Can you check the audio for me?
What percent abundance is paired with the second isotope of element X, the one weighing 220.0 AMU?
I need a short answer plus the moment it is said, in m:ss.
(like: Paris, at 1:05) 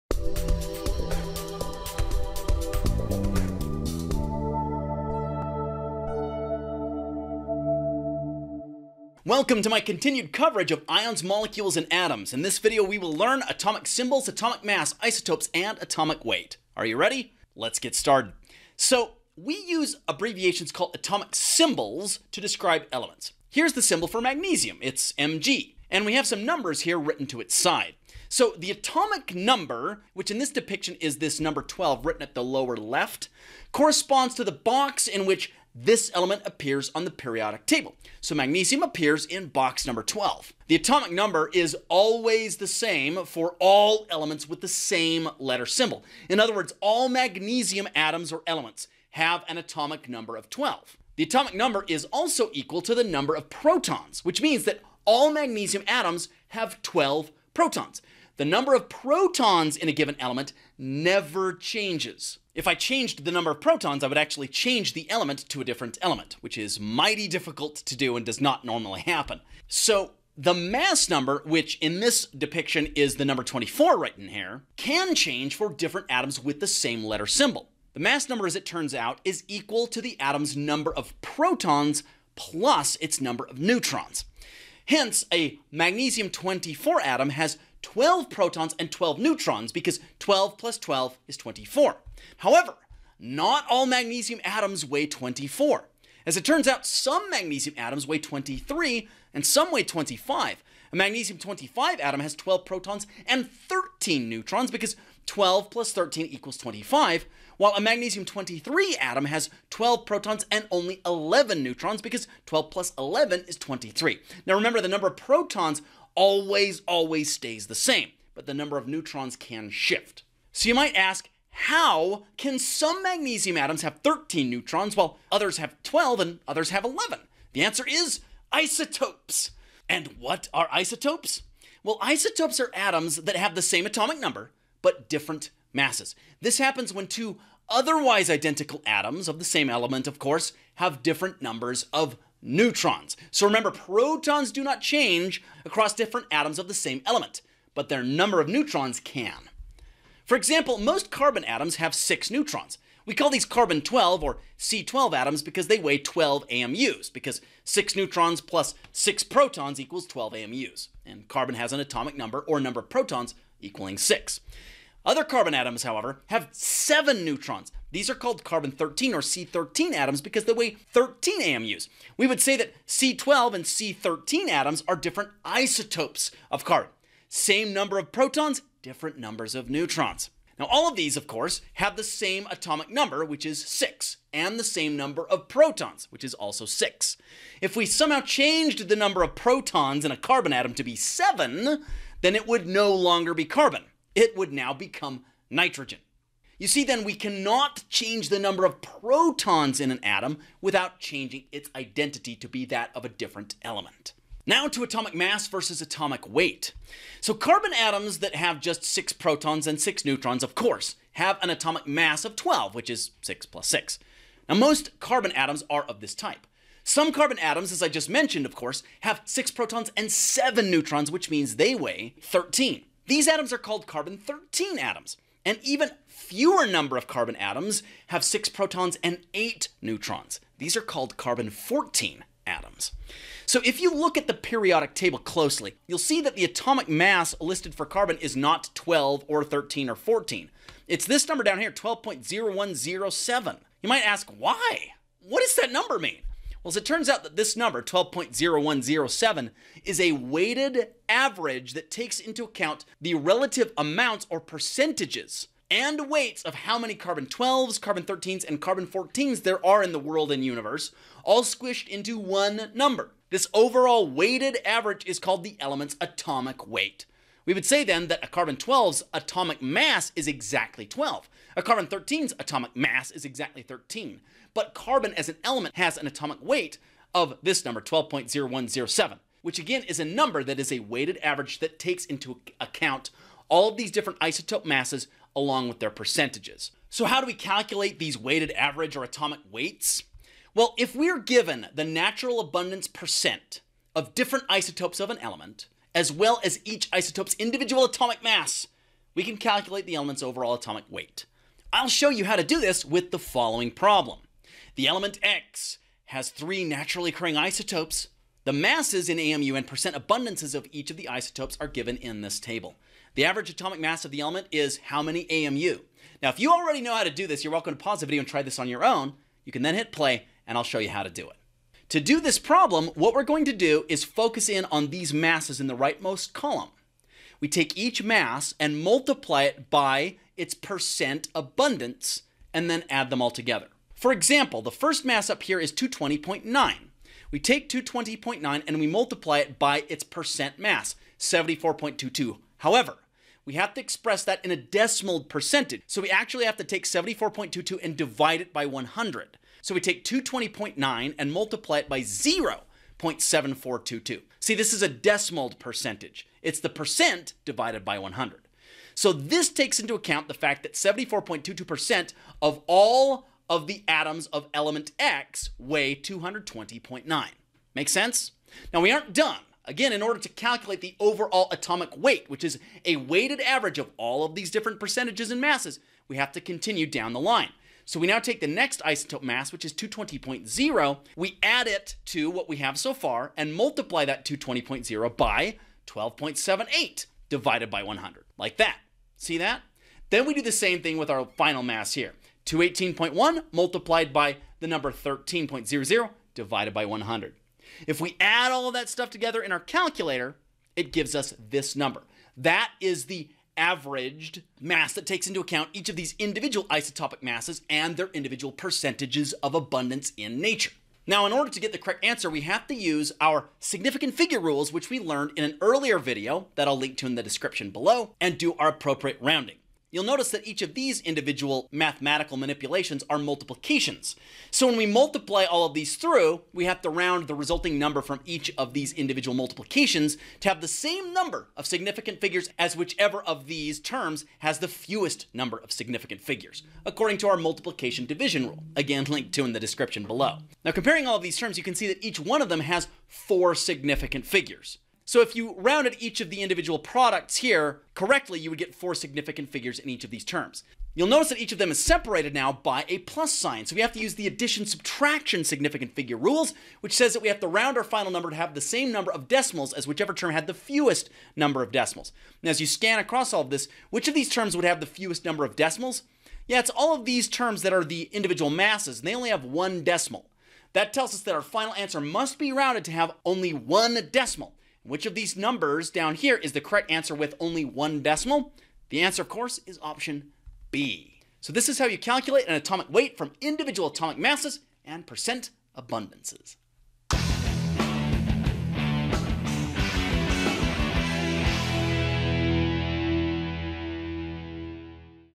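12.78, at 6:25.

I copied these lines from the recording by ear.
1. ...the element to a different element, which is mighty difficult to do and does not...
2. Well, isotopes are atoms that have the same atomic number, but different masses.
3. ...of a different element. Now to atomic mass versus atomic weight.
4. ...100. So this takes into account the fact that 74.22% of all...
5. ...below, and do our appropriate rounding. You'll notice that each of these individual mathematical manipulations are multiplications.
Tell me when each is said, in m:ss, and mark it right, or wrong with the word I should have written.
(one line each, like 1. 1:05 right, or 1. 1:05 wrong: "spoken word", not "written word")
1. 1:04 right
2. 2:11 right
3. 3:22 right
4. 5:57 right
5. 6:57 right.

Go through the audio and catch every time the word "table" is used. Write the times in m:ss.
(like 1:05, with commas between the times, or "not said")
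0:37, 3:54, 5:12.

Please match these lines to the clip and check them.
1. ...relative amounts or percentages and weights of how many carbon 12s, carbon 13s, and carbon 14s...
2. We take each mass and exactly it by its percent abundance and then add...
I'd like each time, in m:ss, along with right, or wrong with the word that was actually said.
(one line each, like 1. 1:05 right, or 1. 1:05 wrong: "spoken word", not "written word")
1. 4:13 right
2. 5:27 wrong: "multiply", not "exactly".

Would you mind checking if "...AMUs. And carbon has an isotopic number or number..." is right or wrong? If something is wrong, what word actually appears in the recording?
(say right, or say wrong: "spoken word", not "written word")
wrong: "atomic", not "isotopic".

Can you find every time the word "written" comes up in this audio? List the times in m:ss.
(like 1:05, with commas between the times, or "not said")
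0:26, 0:32.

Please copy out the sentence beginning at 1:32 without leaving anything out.
However, not all magnesium atoms weigh 24.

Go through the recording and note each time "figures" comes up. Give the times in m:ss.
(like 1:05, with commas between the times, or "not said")
6:54, 7:12, 7:16, 7:24, 7:29, 7:35.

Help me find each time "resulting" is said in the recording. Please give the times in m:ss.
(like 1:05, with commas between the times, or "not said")
7:07.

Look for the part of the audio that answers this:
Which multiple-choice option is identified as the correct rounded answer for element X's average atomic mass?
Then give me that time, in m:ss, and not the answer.
7:59.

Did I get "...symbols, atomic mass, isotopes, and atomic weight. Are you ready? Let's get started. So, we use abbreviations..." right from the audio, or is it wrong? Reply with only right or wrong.
right.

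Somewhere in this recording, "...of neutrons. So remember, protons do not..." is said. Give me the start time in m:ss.
2:21.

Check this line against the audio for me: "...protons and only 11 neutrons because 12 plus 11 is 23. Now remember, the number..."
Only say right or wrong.
right.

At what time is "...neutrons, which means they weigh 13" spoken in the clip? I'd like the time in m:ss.
3:40.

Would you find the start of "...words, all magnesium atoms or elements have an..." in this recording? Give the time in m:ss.
0:46.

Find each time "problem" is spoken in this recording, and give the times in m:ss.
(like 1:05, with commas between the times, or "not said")
5:03, 5:22.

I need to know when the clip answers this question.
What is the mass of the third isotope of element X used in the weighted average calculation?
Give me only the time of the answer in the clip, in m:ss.
6:32.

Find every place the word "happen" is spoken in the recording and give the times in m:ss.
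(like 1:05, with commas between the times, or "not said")
1:09, 2:16.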